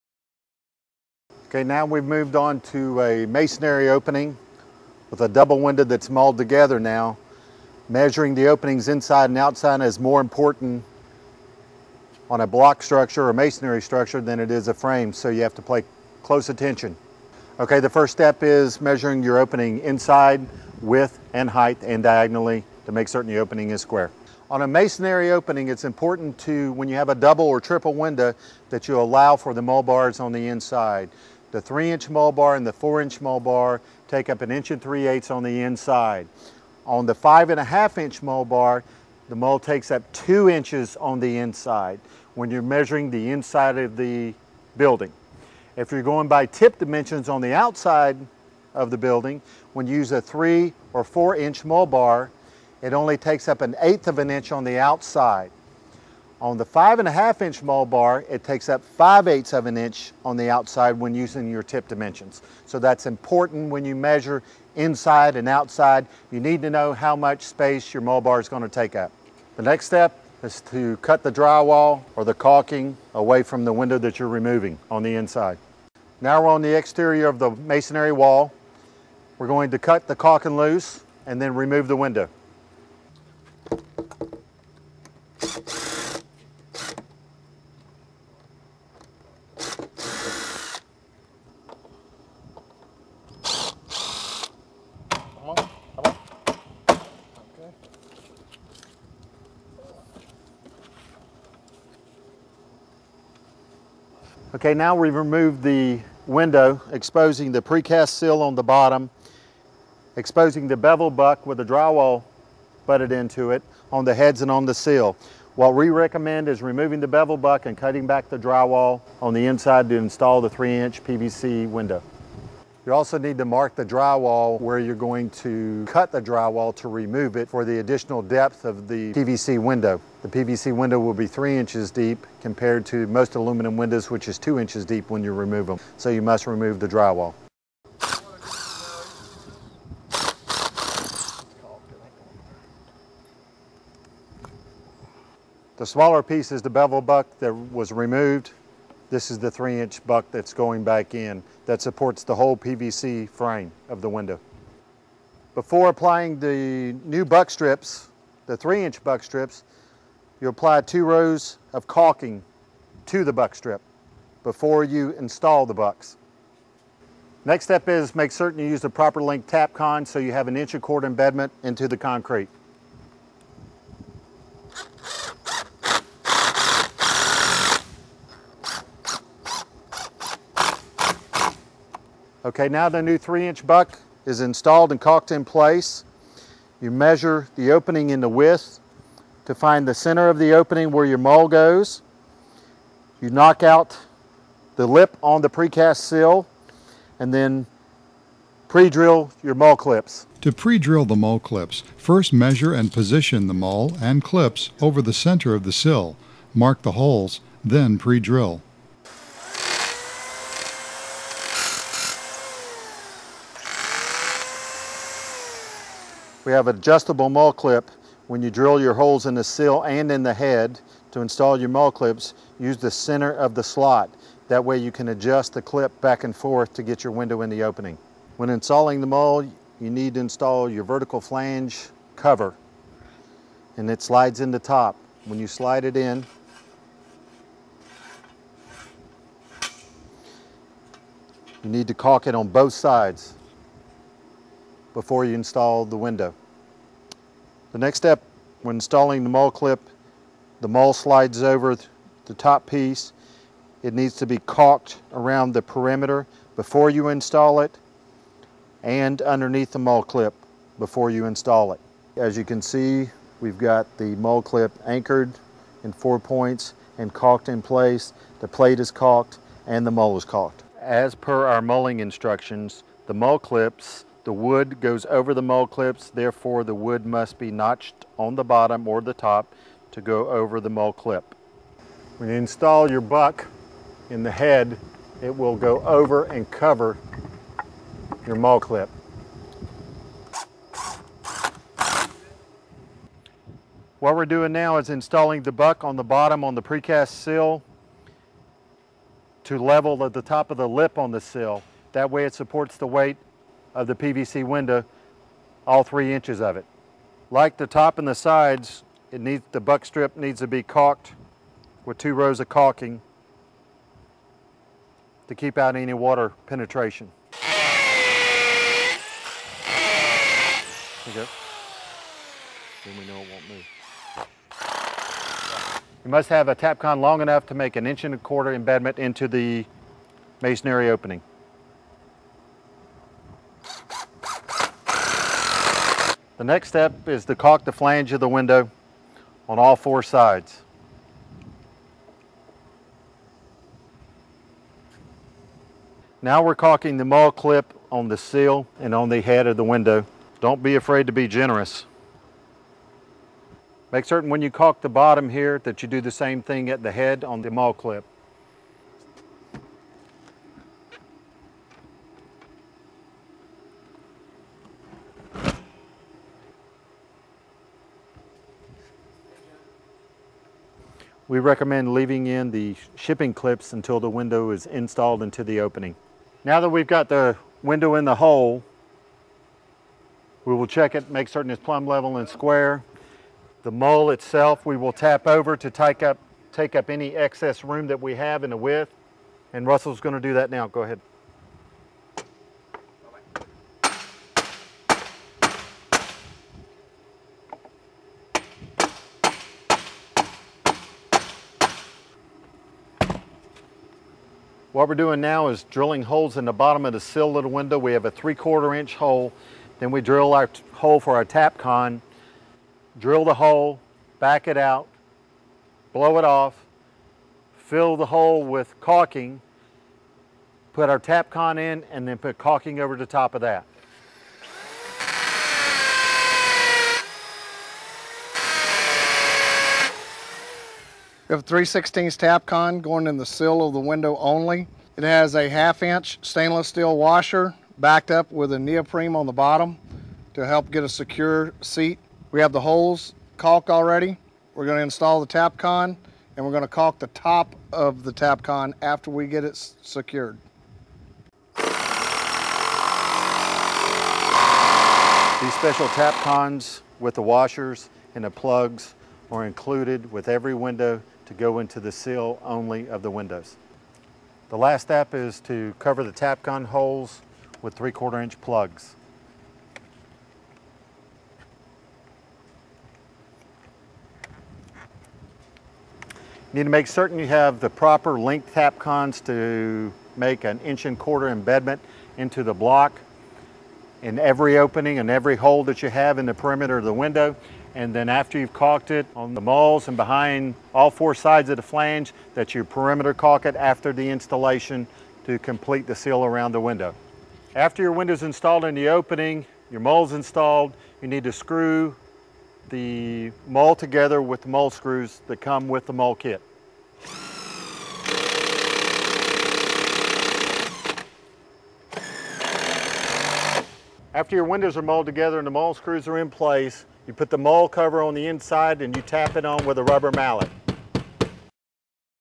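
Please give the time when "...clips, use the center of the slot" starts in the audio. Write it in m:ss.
3:41.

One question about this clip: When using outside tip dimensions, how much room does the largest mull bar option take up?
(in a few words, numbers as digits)
5/8 of an inch.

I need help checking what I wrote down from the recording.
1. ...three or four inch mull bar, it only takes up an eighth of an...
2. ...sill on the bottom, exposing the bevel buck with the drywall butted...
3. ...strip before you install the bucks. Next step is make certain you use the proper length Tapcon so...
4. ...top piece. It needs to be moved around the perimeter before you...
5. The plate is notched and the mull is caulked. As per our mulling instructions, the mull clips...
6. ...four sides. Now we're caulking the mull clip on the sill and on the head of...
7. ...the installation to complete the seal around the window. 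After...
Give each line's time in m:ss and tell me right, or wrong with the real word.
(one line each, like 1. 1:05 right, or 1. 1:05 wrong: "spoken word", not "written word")
1. 0:50 right
2. 1:48 right
3. 2:43 right
4. 4:12 wrong: "caulked", not "moved"
5. 4:28 wrong: "caulked", not "notched"
6. 5:39 right
7. 8:13 right.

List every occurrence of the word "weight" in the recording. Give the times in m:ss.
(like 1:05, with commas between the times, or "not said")
5:02.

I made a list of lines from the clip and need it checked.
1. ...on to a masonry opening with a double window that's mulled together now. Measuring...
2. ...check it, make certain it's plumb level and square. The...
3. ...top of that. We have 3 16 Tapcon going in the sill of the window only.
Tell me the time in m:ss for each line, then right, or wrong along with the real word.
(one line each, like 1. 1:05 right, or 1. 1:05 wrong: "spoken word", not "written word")
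1. 0:02 right
2. 6:20 right
3. 7:03 right.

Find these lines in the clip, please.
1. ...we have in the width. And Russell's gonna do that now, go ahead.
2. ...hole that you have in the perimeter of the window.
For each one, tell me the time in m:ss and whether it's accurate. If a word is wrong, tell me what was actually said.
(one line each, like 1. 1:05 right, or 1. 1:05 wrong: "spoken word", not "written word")
1. 6:28 right
2. 8:05 right.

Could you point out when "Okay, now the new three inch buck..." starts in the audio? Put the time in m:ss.
3:02.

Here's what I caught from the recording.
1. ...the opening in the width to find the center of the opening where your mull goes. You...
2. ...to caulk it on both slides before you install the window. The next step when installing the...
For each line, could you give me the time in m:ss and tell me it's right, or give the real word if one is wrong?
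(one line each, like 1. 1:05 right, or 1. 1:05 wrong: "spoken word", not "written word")
1. 3:07 right
2. 4:01 wrong: "sides", not "slides".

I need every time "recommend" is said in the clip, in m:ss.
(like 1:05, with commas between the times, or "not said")
1:55, 6:11.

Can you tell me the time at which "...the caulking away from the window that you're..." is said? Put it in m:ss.
1:12.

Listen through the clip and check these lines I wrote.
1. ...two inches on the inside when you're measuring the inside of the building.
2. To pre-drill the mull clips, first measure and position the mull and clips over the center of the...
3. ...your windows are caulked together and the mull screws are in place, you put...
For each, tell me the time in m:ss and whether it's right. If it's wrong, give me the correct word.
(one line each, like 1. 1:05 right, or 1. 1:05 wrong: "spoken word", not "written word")
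1. 0:40 right
2. 3:20 right
3. 8:34 wrong: "mulled", not "caulked".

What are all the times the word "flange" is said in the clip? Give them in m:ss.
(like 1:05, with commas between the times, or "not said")
3:51, 5:37, 8:11.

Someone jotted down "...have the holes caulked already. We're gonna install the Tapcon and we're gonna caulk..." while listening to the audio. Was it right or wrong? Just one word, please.
right.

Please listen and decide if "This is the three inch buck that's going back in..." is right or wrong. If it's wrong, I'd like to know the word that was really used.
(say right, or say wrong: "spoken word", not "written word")
right.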